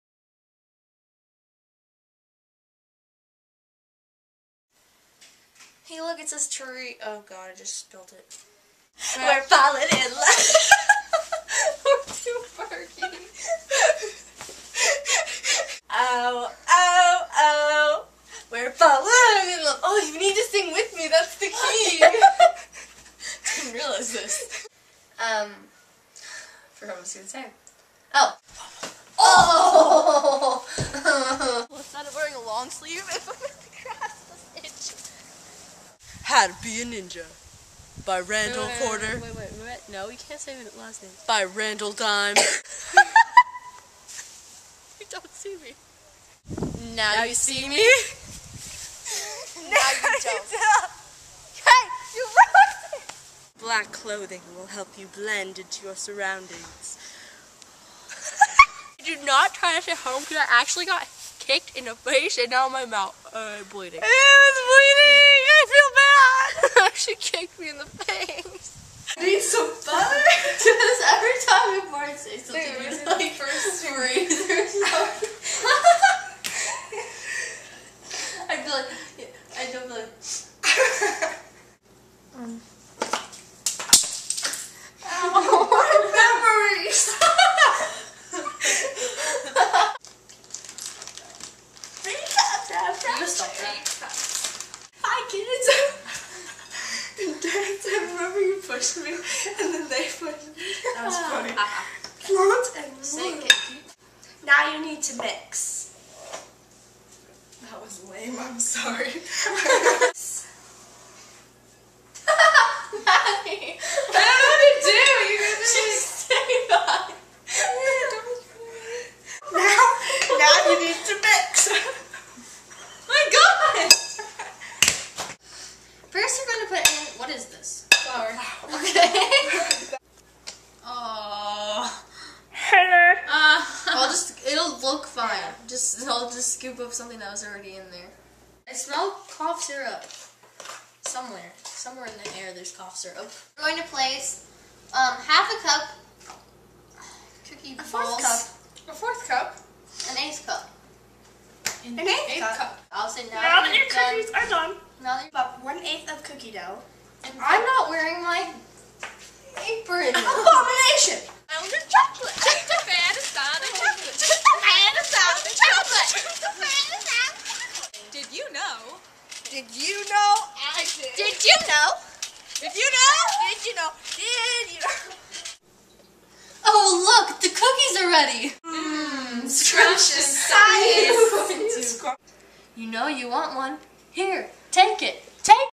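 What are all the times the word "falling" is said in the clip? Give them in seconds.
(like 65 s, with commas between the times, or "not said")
9 s, 18 s.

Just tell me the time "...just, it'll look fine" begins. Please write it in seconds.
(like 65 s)
134 s.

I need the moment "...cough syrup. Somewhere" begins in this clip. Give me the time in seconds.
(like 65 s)
139 s.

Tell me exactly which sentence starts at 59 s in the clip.
Do not try this at home because I actually got kicked in the face and now my mouth uh, bleeding.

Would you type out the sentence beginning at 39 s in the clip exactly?
Wait, wait, wait, No, you can't say it last name.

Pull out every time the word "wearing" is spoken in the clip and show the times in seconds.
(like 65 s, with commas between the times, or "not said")
32 s, 157 s.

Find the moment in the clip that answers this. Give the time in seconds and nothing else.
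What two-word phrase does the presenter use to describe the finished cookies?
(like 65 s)
179 s.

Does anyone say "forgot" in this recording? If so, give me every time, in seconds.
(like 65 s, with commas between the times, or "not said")
26 s.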